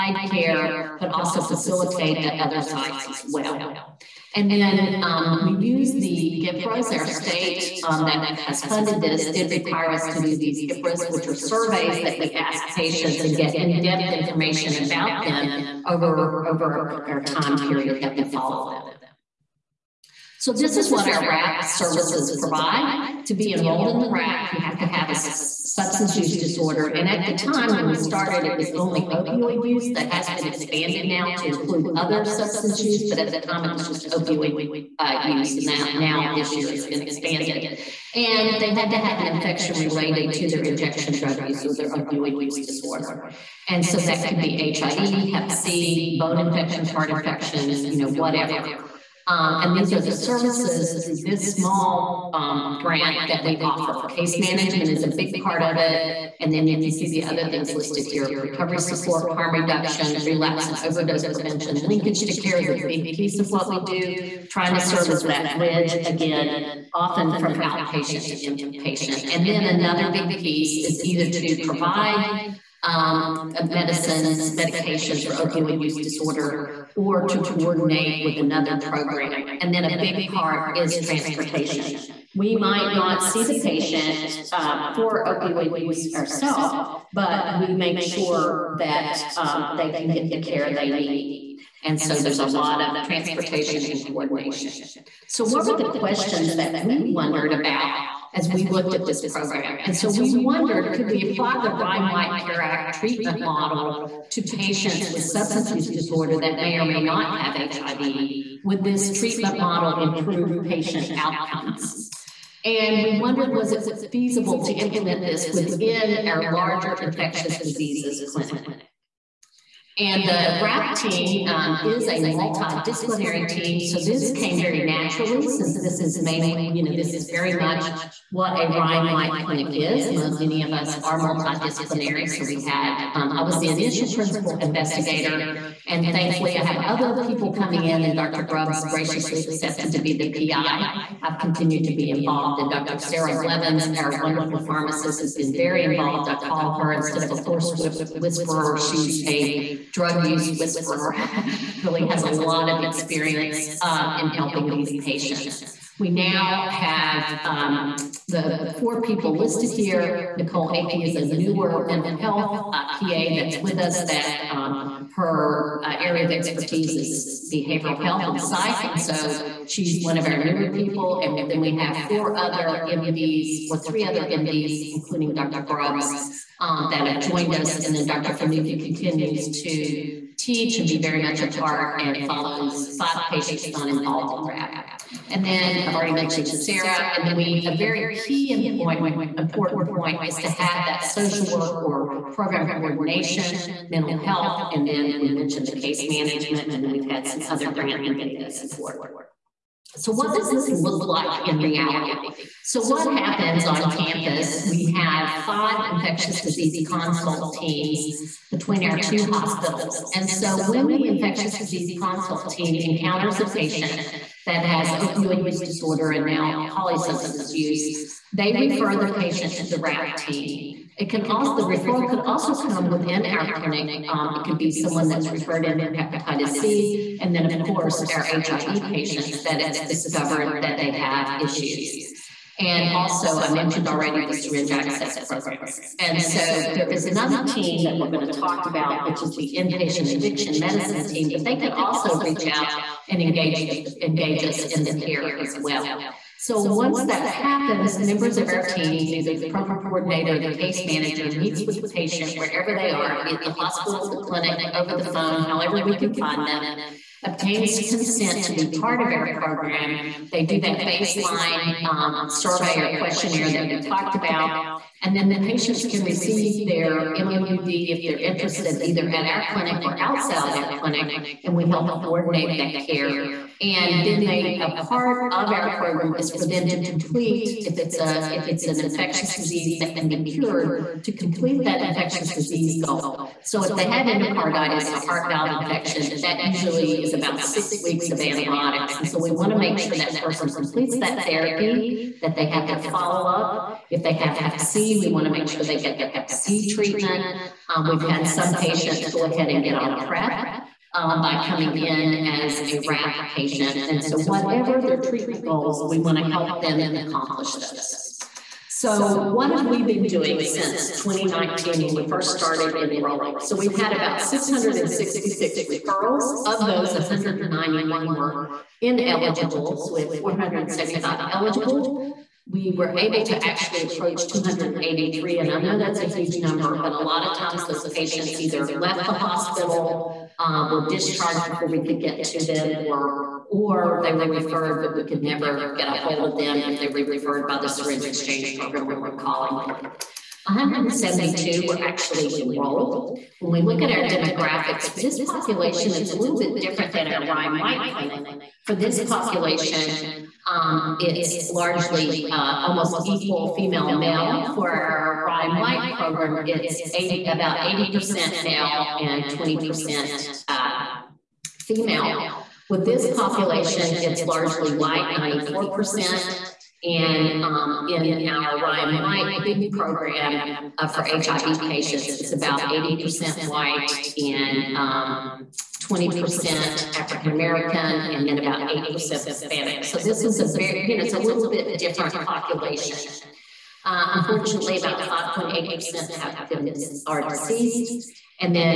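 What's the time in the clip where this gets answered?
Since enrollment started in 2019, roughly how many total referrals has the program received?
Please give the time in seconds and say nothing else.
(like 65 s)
314 s.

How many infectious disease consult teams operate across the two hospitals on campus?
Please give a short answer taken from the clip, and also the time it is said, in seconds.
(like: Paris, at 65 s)
5, at 205 s.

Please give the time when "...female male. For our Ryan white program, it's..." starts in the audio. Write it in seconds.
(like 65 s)
353 s.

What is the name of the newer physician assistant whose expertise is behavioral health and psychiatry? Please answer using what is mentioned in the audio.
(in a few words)
Nicole Akey.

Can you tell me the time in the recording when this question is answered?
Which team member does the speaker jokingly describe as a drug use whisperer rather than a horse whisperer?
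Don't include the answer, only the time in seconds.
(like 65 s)
142 s.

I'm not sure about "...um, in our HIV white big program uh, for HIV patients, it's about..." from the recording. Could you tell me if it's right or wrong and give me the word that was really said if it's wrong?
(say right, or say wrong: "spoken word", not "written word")
wrong: "Ryan", not "HIV".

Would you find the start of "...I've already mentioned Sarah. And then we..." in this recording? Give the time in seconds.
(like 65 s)
185 s.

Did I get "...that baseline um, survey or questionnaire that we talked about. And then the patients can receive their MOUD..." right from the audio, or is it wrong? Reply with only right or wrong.
right.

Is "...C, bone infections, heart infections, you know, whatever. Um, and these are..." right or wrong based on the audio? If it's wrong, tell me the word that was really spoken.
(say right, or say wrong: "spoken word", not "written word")
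right.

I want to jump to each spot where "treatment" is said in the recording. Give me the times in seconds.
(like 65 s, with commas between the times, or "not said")
102 s, 109 s, 296 s, 304 s.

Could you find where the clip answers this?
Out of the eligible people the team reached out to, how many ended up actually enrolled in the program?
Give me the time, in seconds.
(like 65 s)
340 s.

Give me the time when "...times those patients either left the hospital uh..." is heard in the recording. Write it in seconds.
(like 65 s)
327 s.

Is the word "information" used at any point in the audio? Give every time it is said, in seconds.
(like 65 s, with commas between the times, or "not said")
14 s.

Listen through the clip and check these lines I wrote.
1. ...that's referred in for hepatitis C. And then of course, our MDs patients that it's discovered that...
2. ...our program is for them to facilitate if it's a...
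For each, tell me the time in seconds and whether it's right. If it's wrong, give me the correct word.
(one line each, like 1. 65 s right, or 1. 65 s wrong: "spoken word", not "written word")
1. 225 s wrong: "HIV", not "MDs"
2. 275 s wrong: "complete", not "facilitate".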